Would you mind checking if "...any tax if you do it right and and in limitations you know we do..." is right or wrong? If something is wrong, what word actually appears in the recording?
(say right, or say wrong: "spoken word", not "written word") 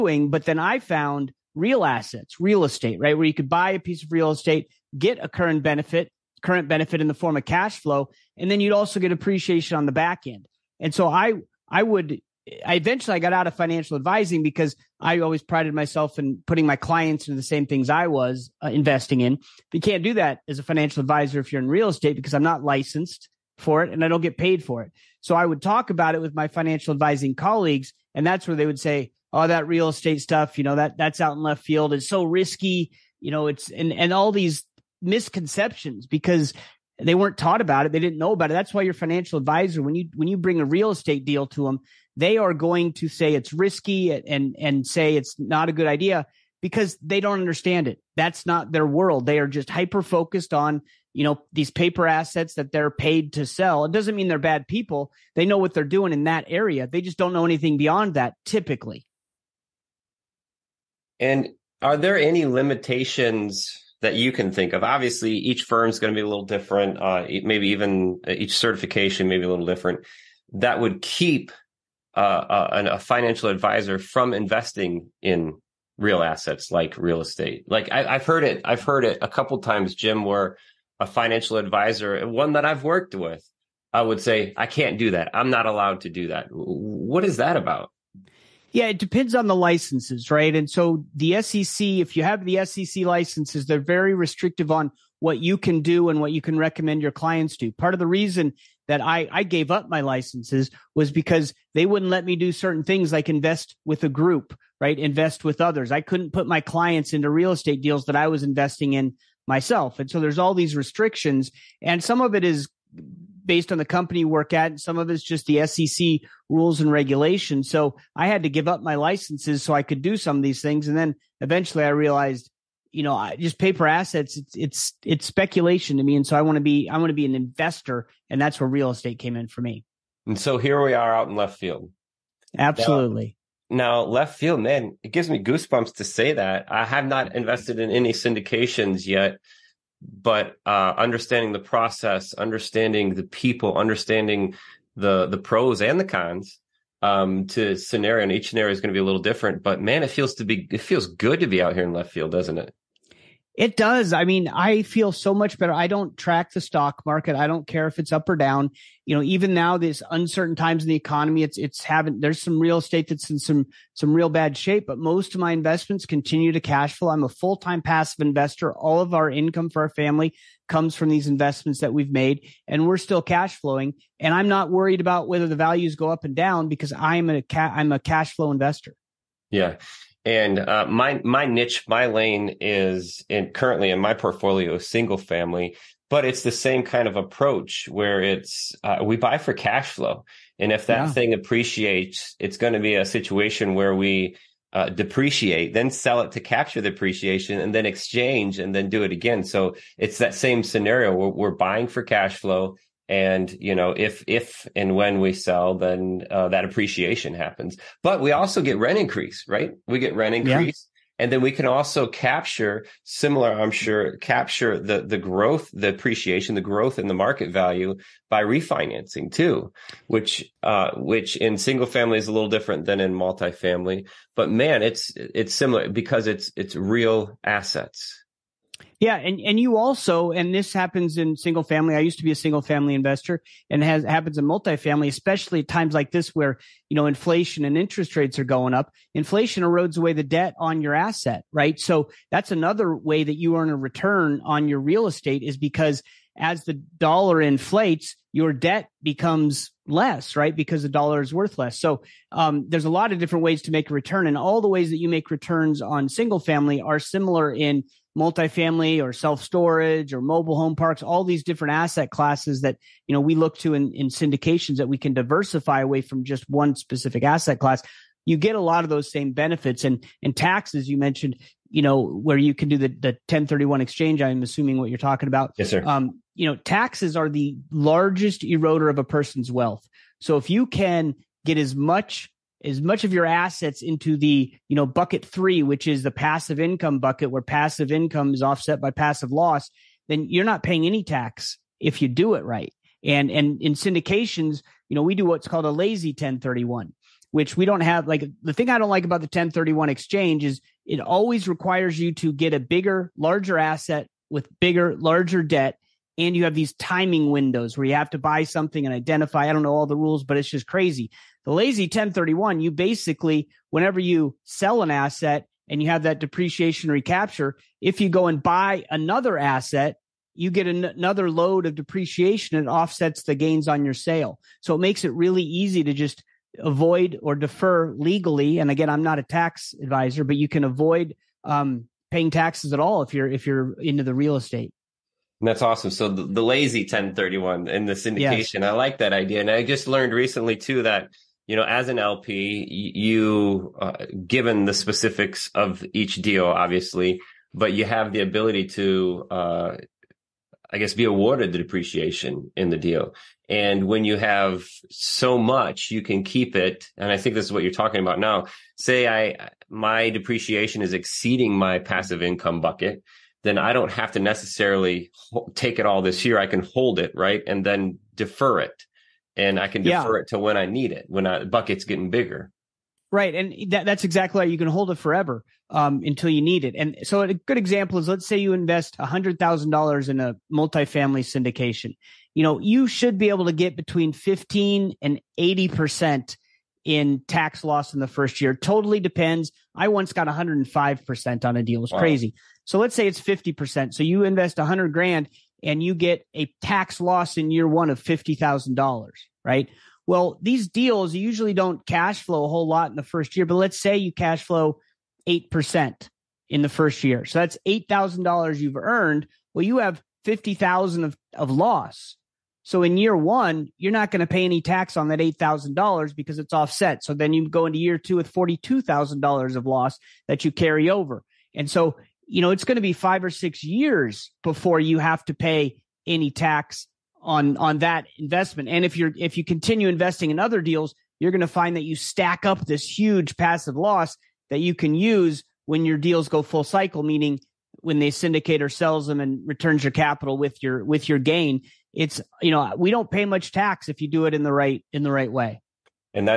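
wrong: "syndications", not "limitations".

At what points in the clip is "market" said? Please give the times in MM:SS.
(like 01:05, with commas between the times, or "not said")
02:37, 03:37.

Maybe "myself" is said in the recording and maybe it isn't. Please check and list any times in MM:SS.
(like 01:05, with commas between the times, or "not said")
00:15, 01:49.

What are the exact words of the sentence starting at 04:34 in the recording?
I'm assuming what you're talking about.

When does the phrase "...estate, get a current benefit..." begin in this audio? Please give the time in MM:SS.
00:04.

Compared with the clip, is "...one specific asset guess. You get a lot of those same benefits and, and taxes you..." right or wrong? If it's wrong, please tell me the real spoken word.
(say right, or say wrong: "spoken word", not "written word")
wrong: "class", not "guess".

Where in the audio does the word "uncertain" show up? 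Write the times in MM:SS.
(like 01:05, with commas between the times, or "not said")
02:40.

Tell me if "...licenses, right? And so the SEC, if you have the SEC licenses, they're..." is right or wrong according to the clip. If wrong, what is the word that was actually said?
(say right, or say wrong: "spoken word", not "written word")
right.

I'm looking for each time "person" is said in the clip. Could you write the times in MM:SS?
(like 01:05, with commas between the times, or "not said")
04:39.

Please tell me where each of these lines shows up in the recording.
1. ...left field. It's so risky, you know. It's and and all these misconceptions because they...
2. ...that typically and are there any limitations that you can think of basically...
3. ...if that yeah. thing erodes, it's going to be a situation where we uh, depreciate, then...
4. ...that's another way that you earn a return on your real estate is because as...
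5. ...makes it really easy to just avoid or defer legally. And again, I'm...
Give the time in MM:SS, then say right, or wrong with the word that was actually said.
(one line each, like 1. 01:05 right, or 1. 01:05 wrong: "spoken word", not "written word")
1. 00:31 right
2. 00:58 wrong: "obviously", not "basically"
3. 03:10 wrong: "appreciates", not "erodes"
4. 04:02 right
5. 05:24 right.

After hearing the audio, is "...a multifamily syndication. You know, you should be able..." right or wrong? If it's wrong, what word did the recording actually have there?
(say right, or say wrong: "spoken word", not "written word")
right.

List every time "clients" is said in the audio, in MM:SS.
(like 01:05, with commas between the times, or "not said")
00:16, 01:37, 01:46.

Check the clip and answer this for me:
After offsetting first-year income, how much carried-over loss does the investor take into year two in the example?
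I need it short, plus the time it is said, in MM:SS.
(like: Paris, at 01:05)
$42,000, at 06:58.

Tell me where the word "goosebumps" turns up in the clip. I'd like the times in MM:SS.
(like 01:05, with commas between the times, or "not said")
02:15.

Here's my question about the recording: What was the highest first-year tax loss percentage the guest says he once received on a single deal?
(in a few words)
105%.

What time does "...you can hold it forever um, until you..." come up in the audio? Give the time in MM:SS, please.
06:14.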